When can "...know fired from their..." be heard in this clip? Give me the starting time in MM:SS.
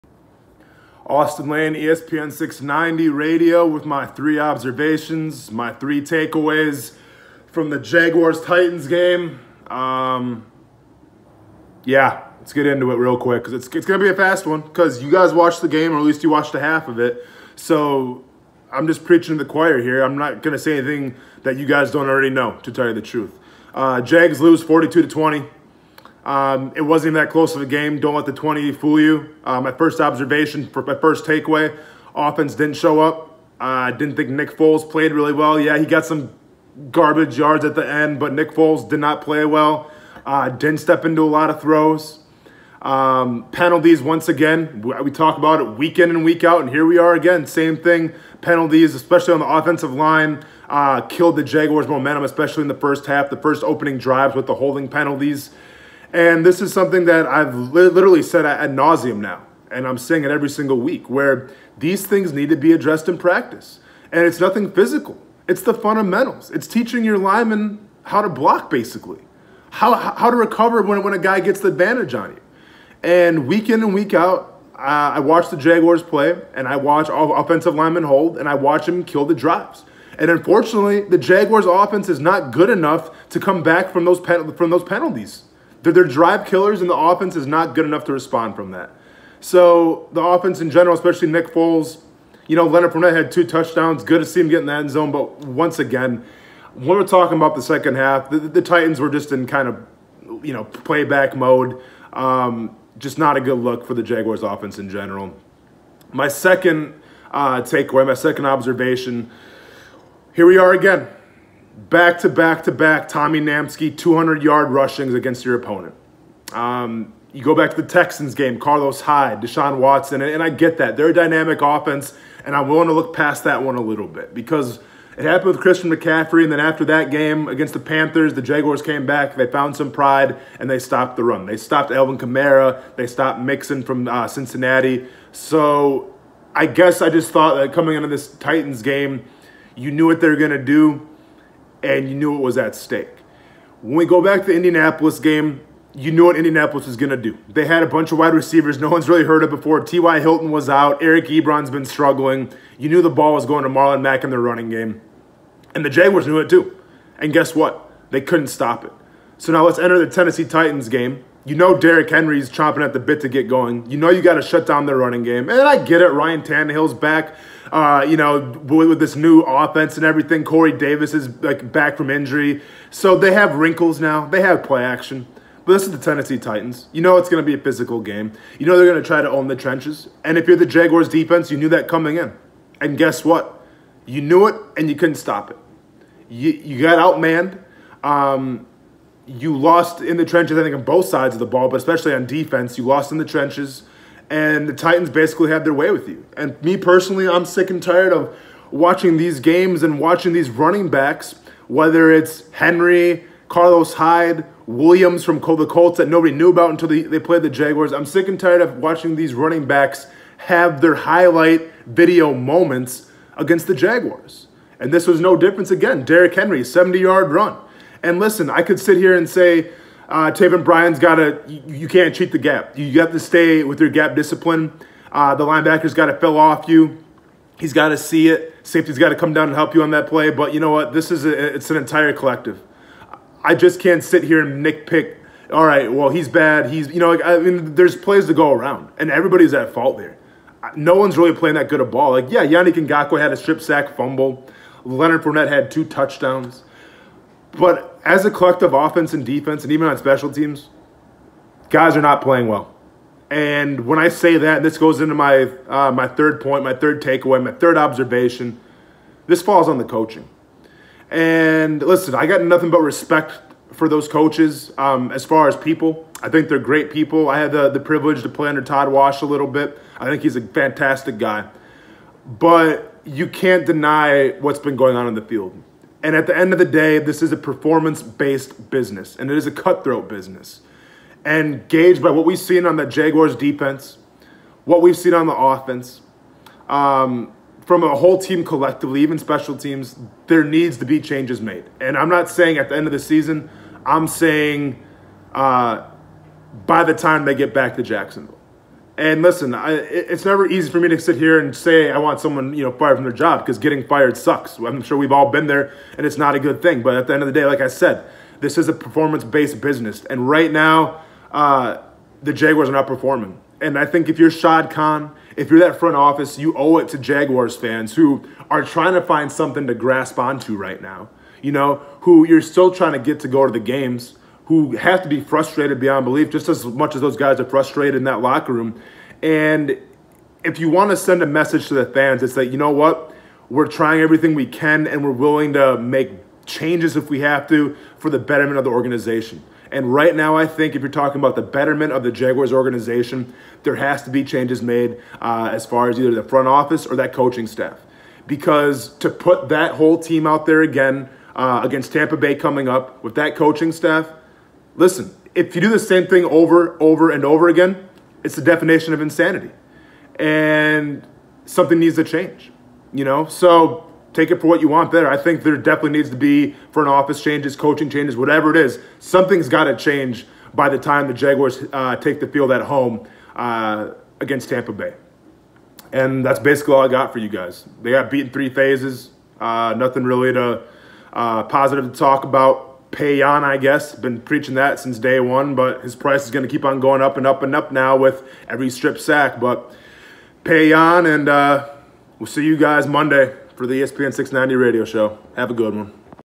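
05:02.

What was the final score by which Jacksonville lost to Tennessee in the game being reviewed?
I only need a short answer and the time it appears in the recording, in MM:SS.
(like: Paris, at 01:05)
42 to 20, at 00:24.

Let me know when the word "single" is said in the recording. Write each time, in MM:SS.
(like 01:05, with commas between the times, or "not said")
01:00.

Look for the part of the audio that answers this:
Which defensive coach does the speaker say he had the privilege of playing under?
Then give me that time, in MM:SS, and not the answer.
04:28.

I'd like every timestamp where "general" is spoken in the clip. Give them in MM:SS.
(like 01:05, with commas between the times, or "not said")
01:30, 01:44.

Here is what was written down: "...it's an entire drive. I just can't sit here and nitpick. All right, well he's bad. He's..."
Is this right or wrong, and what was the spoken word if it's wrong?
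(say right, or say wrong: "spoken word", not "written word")
wrong: "collective", not "drive".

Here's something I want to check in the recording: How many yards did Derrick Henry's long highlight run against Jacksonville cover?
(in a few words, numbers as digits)
70.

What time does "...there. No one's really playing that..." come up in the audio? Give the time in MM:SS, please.
03:59.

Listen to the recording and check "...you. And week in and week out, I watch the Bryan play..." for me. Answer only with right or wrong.
wrong.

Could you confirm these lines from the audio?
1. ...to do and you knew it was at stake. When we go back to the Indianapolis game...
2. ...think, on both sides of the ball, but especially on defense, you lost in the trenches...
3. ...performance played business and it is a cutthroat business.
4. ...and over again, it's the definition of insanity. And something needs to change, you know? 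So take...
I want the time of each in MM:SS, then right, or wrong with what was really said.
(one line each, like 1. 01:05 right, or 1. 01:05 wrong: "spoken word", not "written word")
1. 02:20 right
2. 03:10 right
3. 04:37 wrong: "based", not "played"
4. 05:57 right.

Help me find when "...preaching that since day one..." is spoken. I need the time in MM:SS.
06:24.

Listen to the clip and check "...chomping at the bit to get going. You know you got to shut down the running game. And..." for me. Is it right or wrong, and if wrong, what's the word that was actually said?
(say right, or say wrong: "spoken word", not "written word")
right.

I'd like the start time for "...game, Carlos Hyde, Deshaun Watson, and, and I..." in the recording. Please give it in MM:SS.
01:58.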